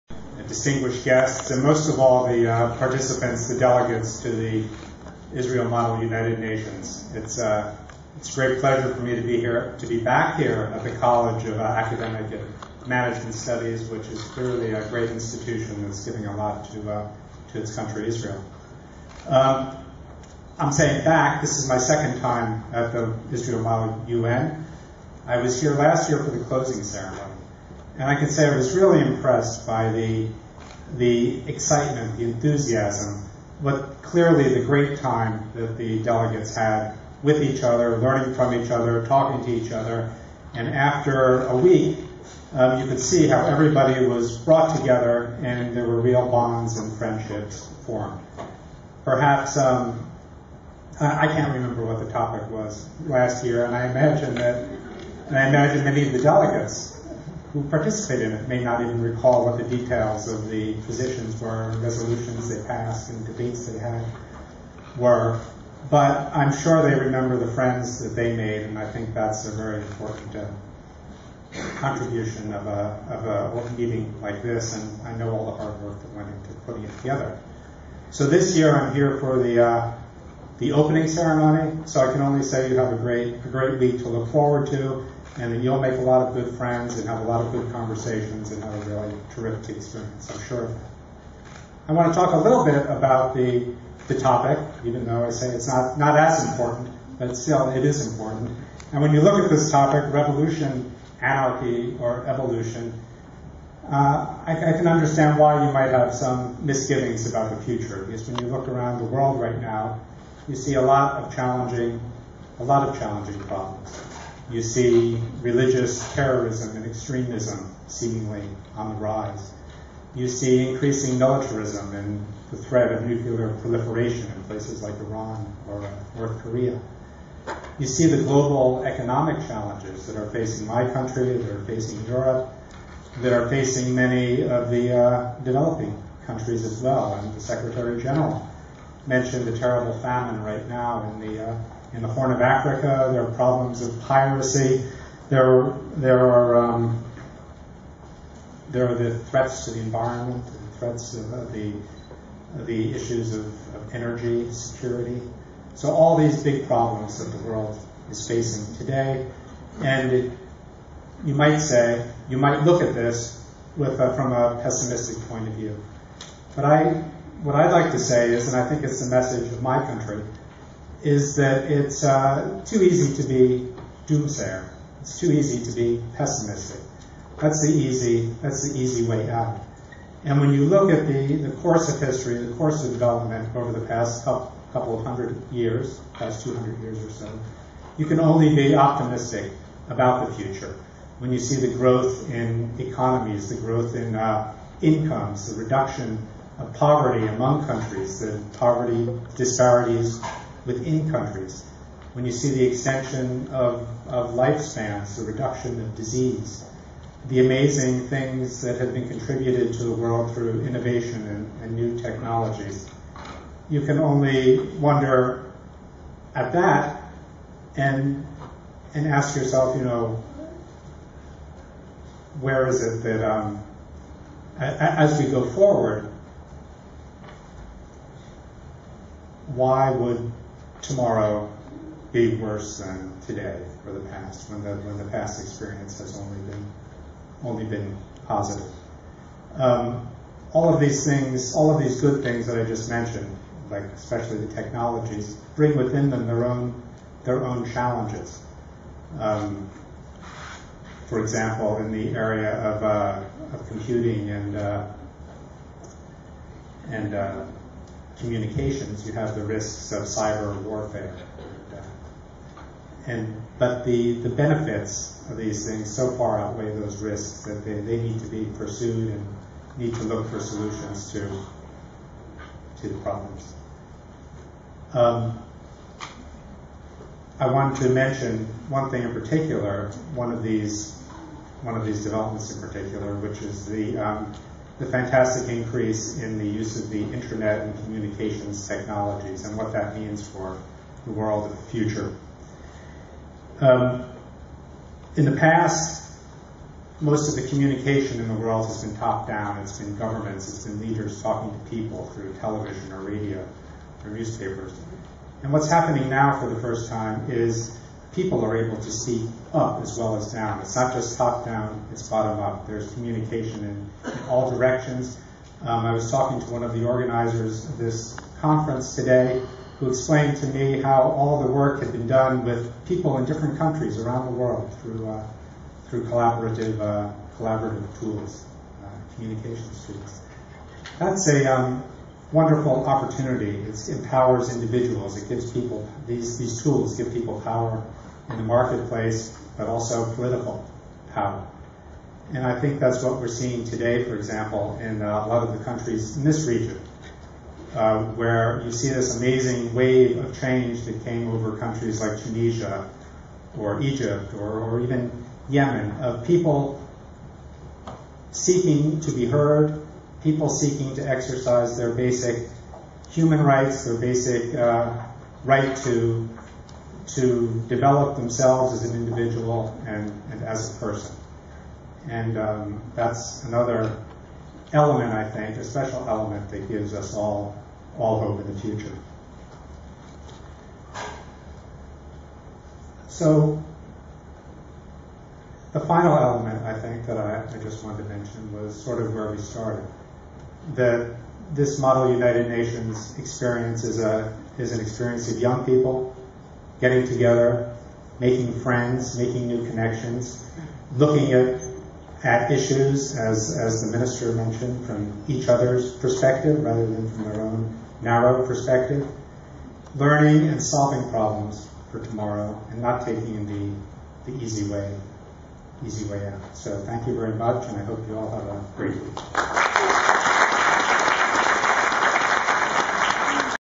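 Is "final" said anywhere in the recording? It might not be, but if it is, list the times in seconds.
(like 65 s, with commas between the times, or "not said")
385 s.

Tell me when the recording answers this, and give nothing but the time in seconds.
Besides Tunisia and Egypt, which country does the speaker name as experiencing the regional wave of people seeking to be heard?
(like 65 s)
355 s.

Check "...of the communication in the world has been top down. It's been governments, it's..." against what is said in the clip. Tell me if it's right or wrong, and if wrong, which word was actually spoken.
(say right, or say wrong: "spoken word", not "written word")
right.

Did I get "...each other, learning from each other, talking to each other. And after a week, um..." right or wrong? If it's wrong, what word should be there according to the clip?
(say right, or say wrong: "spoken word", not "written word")
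right.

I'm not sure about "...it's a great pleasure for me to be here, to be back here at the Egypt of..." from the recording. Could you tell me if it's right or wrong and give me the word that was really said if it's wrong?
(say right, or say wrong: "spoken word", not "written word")
wrong: "College", not "Egypt".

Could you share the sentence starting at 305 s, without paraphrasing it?
And what's happening now for the first time is people are able to see up as well as down.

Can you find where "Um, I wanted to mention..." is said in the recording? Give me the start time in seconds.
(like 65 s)
274 s.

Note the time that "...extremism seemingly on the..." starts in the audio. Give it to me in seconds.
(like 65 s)
116 s.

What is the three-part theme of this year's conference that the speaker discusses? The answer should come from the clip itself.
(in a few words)
Revolution, anarchy, or evolution.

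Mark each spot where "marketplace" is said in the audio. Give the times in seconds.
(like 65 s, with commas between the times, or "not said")
338 s.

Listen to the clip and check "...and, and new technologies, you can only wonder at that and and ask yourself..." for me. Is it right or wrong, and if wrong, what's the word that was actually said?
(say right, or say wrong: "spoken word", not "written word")
right.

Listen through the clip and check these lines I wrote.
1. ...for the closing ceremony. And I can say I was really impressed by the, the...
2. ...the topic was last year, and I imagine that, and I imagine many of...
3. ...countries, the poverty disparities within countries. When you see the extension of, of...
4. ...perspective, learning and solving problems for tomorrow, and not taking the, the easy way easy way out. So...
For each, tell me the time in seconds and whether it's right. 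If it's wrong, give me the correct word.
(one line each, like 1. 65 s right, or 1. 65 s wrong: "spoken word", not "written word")
1. 26 s right
2. 52 s right
3. 197 s right
4. 408 s right.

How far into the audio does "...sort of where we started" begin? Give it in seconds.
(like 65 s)
388 s.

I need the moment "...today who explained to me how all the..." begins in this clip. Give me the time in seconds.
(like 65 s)
318 s.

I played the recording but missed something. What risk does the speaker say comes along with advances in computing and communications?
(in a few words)
Cyber warfare.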